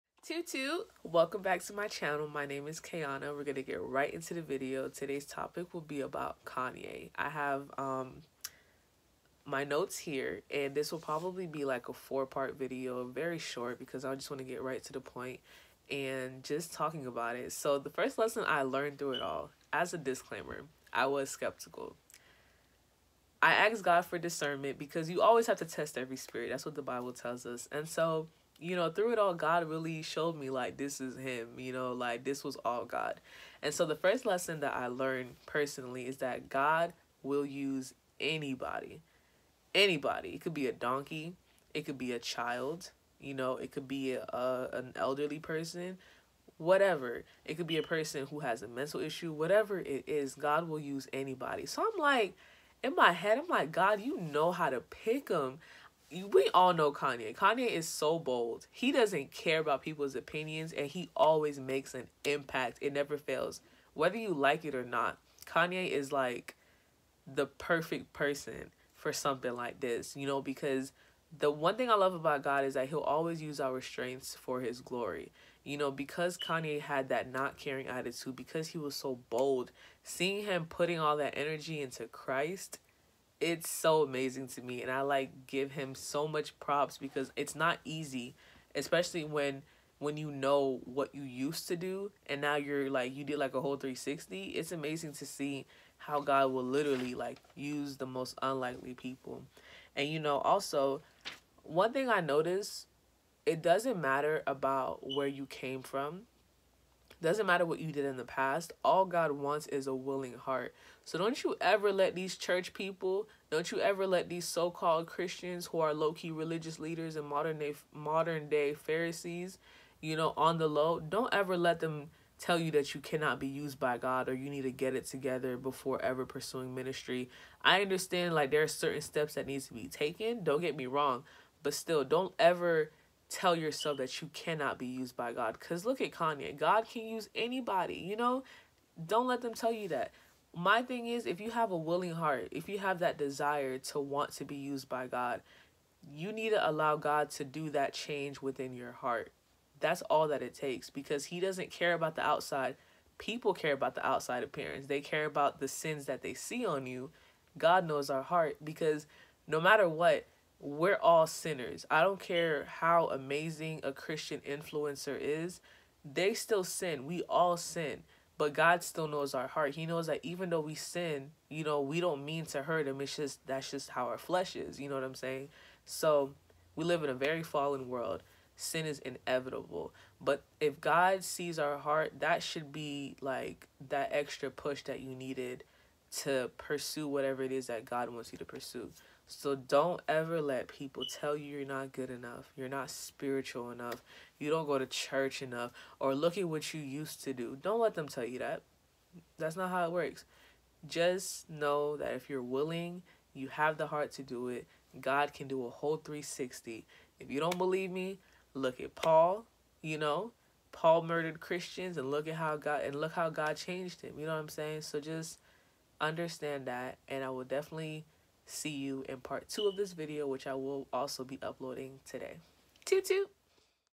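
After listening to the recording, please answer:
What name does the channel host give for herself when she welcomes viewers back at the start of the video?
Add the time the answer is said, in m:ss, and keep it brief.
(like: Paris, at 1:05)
Kayanah, at 0:02.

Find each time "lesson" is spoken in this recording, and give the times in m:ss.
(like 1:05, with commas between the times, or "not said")
0:18, 0:34.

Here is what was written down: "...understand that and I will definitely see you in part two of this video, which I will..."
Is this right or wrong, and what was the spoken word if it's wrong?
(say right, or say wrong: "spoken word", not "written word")
right.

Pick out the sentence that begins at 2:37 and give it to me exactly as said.
God knows our heart because no matter what, we're all sinners.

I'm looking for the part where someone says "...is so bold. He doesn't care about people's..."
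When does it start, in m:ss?
0:57.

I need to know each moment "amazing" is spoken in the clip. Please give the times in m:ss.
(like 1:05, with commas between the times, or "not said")
1:24, 1:34, 2:43.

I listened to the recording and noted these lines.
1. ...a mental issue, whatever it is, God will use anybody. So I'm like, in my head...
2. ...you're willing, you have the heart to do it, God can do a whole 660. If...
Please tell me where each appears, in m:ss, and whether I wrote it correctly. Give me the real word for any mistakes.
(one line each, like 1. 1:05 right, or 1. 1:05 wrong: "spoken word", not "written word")
1. 0:48 right
2. 3:22 wrong: "360", not "660".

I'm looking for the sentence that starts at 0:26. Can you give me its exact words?
That's what the Bible tells us.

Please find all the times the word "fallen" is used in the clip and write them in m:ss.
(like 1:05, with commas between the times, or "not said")
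2:57.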